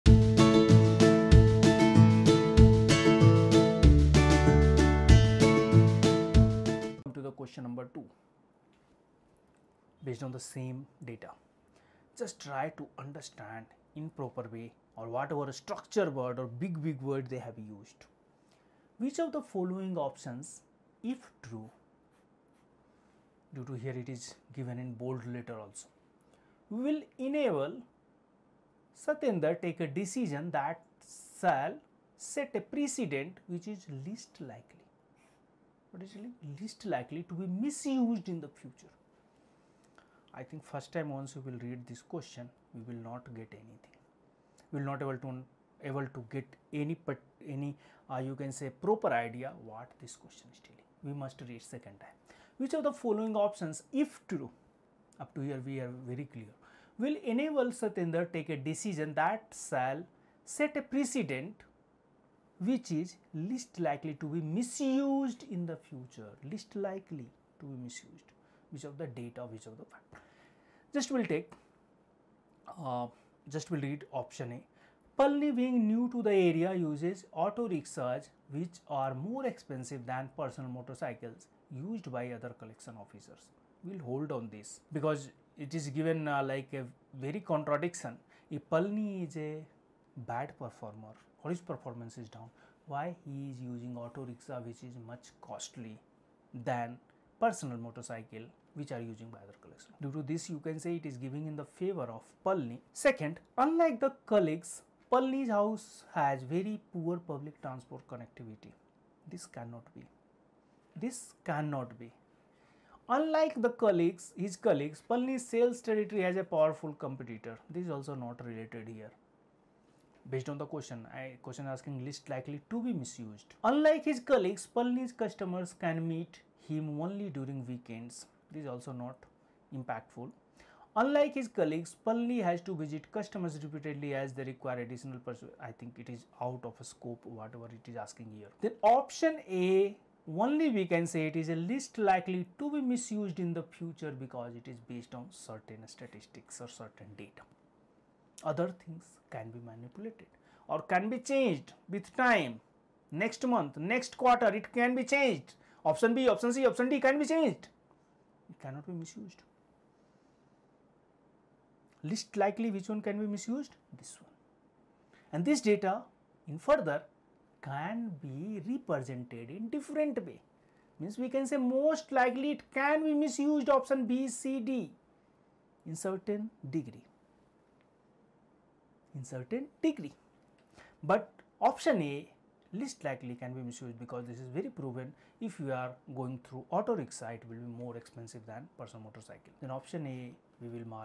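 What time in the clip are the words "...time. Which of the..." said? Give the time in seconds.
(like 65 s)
51 s.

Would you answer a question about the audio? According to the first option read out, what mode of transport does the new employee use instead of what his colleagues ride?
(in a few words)
Auto rickshaws.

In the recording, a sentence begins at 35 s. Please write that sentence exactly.
What is least likely to be misused in the future.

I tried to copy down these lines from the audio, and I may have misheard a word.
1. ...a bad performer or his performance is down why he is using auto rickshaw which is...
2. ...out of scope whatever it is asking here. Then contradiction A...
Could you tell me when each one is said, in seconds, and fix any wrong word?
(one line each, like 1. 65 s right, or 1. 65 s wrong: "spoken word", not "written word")
1. 89 s right
2. 136 s wrong: "option", not "contradiction".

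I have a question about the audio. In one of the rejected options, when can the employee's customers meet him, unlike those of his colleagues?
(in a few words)
During weekends.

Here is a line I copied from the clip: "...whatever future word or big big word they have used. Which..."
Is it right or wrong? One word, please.
wrong.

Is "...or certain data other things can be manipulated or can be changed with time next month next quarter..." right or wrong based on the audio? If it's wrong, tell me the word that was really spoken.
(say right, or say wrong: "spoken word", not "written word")
right.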